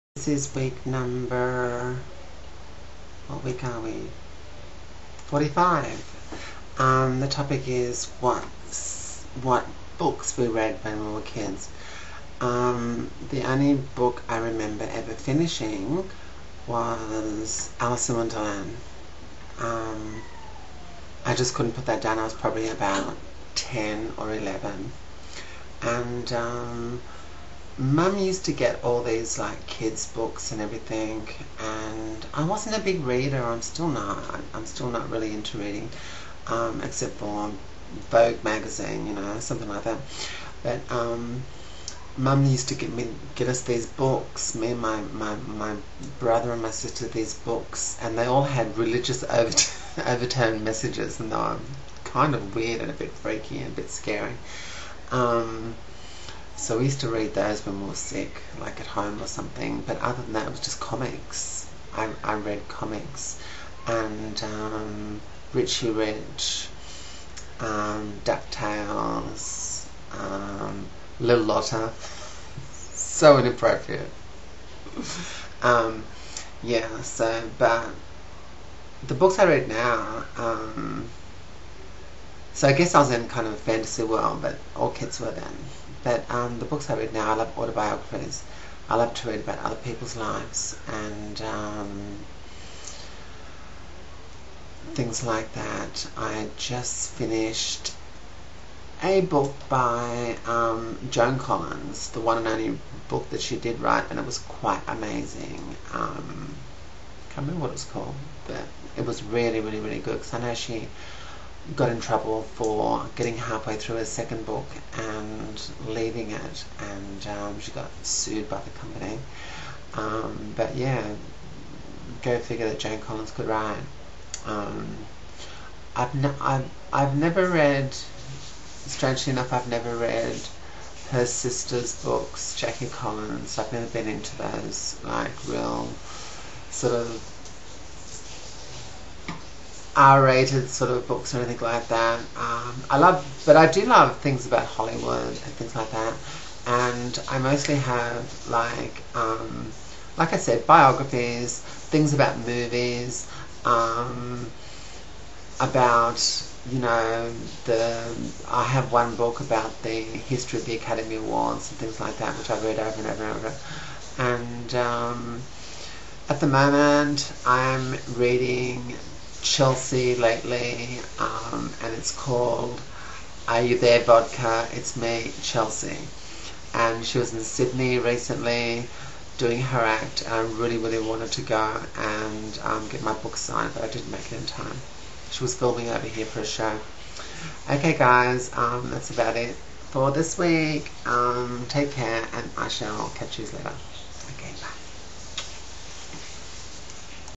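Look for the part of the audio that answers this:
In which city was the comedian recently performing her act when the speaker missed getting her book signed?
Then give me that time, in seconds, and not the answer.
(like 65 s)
177 s.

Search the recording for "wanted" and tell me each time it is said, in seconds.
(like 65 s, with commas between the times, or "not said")
180 s.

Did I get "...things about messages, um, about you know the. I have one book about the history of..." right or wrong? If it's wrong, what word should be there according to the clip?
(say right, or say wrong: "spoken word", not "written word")
wrong: "movies", not "messages".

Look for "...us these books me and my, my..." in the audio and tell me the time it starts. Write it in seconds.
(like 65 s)
43 s.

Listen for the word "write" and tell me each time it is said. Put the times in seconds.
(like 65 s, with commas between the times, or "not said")
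103 s, 123 s.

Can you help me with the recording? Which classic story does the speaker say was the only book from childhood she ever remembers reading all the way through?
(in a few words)
Alice in Wonderland.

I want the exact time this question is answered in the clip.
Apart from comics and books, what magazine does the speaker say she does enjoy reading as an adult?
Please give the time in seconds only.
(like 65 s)
38 s.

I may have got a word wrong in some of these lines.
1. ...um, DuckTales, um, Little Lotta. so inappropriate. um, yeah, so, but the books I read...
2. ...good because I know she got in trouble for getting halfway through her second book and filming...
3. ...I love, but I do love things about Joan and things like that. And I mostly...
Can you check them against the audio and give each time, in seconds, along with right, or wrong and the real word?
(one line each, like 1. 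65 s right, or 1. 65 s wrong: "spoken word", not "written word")
1. 67 s right
2. 109 s wrong: "leaving", not "filming"
3. 142 s wrong: "Hollywood", not "Joan".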